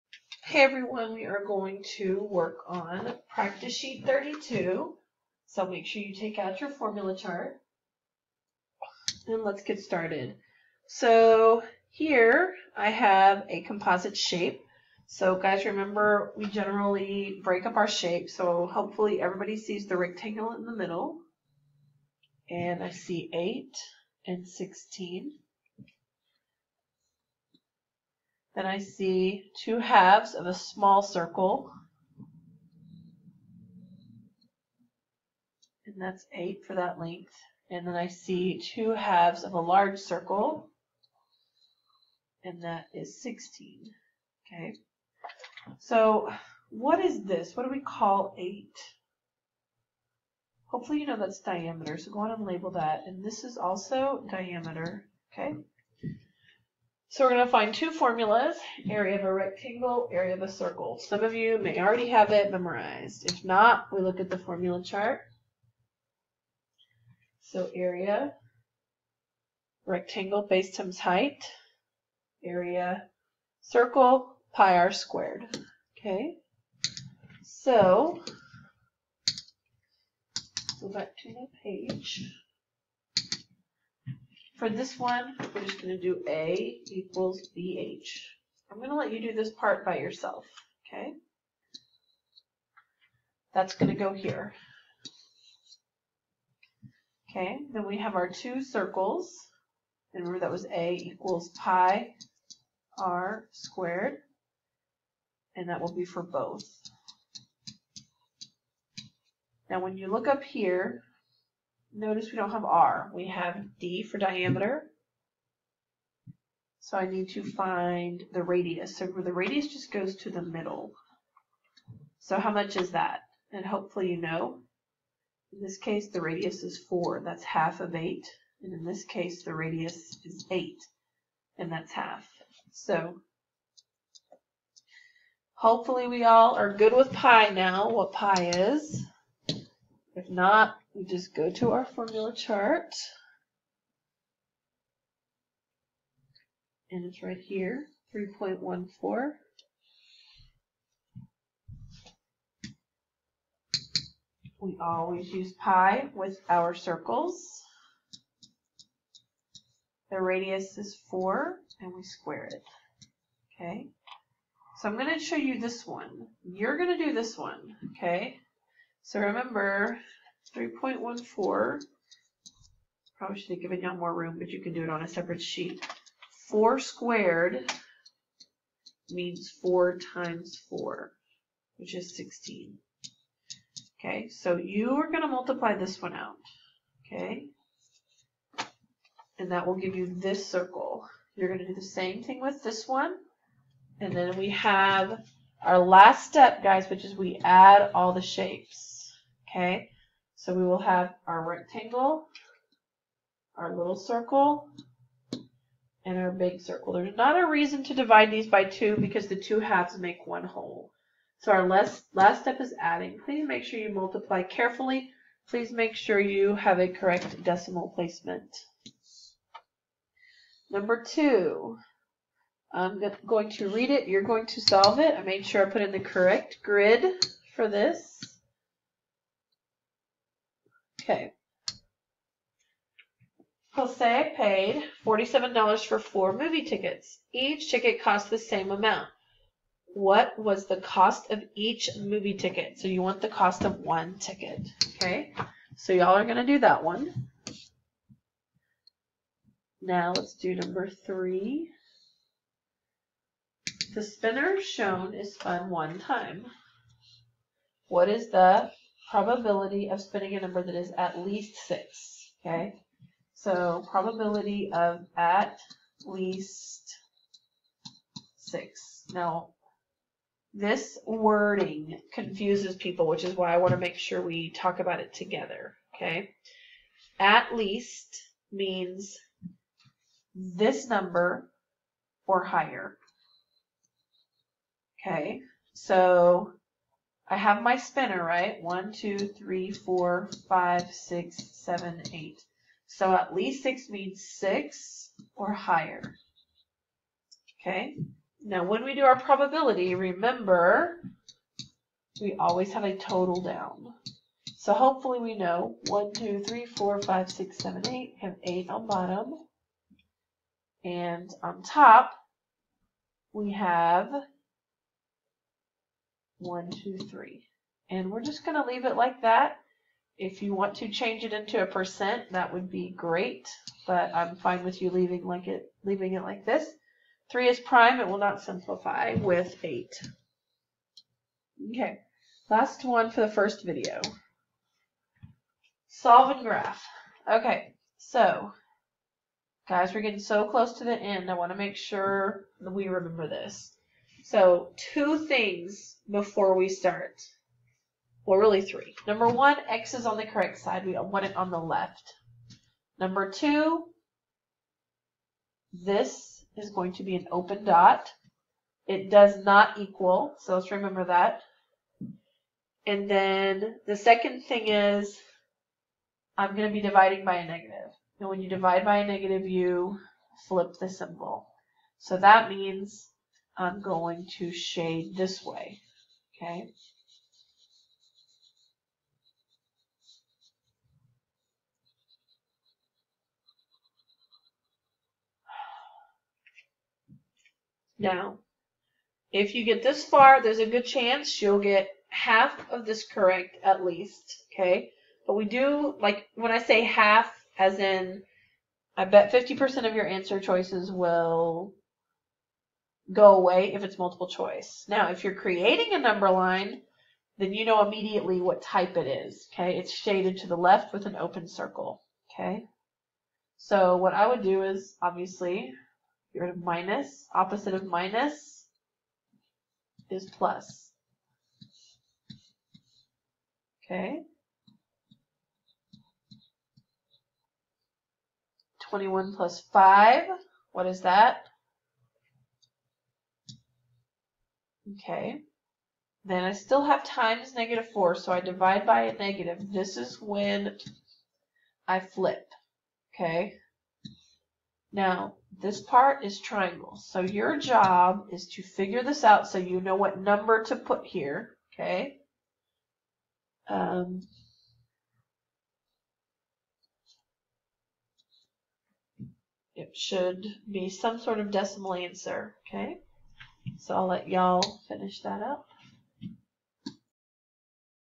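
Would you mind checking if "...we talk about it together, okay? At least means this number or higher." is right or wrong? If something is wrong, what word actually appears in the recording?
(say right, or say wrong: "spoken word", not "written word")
right.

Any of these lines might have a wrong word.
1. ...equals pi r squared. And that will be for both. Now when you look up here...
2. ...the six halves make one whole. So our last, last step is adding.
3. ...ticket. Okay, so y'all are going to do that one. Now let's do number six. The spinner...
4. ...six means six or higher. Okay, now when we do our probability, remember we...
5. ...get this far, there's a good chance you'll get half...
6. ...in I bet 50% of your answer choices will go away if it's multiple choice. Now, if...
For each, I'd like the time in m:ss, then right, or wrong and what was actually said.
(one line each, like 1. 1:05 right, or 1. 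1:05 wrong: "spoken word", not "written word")
1. 1:40 right
2. 3:29 wrong: "two", not "six"
3. 4:04 wrong: "three", not "six"
4. 4:53 right
5. 6:29 right
6. 6:37 right.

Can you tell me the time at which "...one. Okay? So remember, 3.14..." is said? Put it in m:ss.
2:47.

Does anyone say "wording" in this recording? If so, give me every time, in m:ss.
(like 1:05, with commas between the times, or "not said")
4:31.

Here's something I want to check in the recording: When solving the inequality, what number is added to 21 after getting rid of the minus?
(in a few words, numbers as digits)
5.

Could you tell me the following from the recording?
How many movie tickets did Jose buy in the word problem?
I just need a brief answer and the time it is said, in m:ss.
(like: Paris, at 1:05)
4, at 3:55.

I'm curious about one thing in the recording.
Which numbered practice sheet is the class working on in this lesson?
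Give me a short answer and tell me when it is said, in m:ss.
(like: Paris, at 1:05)
32, at 0:03.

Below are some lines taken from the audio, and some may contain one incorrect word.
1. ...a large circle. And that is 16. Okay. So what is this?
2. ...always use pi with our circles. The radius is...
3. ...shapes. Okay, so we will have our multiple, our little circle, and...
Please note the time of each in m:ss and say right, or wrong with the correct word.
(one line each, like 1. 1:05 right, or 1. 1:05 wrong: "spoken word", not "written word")
1. 0:39 right
2. 2:34 right
3. 3:18 wrong: "rectangle", not "multiple".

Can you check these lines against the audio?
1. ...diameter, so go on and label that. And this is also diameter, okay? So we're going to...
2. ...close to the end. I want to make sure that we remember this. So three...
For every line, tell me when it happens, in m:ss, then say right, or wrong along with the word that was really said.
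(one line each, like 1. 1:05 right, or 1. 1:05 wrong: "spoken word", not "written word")
1. 0:51 right
2. 5:40 wrong: "two", not "three".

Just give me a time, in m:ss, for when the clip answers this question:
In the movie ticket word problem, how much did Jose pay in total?
3:55.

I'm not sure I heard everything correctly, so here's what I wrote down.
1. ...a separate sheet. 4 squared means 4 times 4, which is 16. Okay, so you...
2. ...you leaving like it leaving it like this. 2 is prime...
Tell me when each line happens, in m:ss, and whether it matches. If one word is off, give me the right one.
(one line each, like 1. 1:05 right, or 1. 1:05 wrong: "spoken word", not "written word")
1. 2:55 right
2. 5:24 wrong: "3", not "2".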